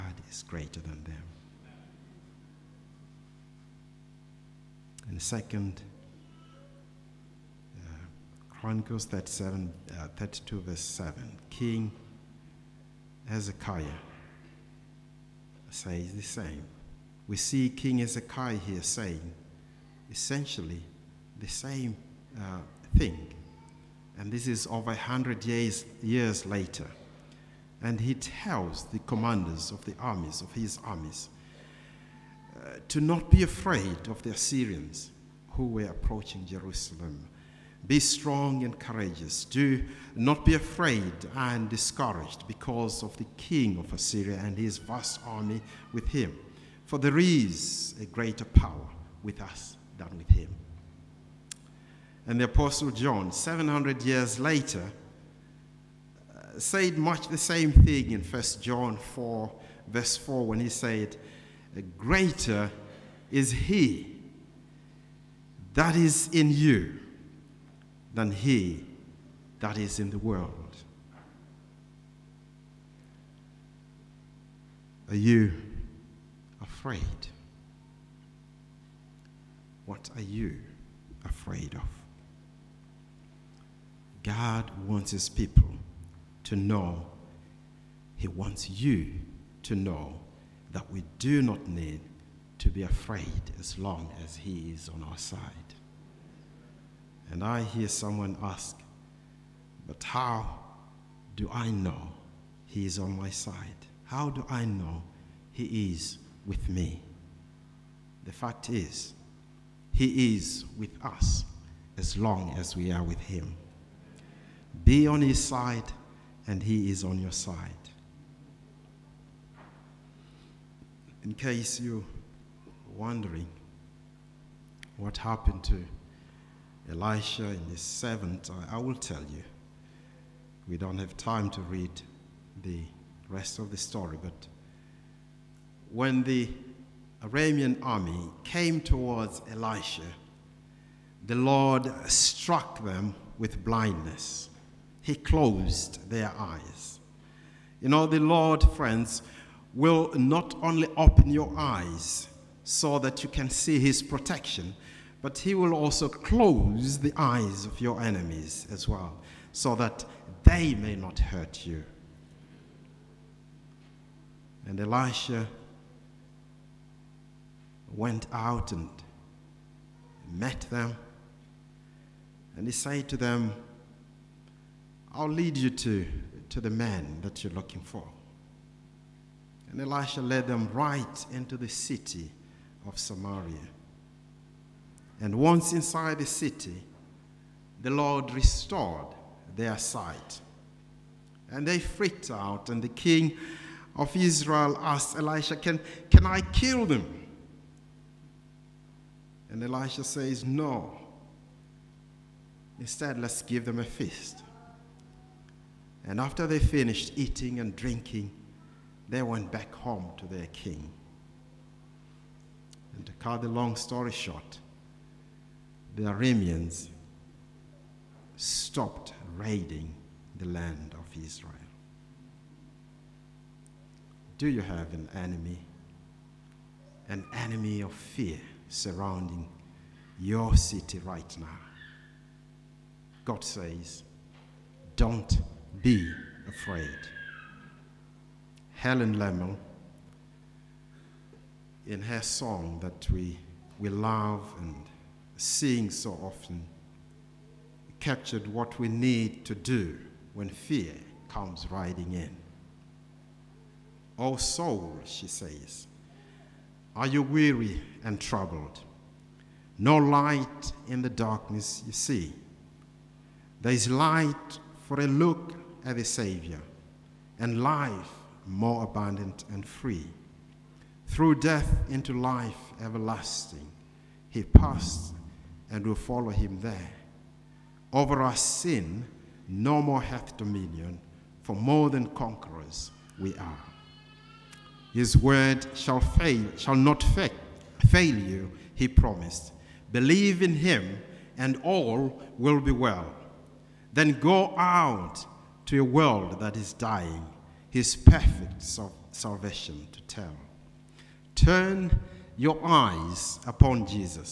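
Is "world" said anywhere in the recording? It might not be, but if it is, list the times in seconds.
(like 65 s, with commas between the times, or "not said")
70 s, 295 s.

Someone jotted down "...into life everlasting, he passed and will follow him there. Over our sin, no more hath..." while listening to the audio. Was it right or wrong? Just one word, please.
right.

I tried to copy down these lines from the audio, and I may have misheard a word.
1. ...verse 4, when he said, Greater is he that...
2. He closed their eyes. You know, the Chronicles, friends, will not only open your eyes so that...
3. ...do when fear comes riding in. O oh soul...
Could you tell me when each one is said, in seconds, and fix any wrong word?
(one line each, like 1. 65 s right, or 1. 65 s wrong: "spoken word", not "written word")
1. 59 s right
2. 145 s wrong: "Lord", not "Chronicles"
3. 249 s right.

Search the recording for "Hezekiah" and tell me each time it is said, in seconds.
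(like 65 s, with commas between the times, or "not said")
13 s, 17 s.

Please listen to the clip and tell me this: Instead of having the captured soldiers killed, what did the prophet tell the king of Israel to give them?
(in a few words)
A feast.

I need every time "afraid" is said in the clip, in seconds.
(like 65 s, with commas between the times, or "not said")
33 s, 40 s, 76 s, 81 s, 92 s, 236 s.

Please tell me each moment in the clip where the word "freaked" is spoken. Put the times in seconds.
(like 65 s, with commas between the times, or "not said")
191 s.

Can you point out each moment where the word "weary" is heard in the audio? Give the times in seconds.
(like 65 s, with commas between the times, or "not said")
257 s.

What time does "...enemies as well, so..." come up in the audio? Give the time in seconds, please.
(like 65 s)
158 s.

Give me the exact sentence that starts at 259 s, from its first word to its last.
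No light in the darkness you see.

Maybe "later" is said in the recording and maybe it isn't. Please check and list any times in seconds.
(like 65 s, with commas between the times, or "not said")
26 s, 54 s.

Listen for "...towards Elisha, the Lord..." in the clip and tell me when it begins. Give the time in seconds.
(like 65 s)
138 s.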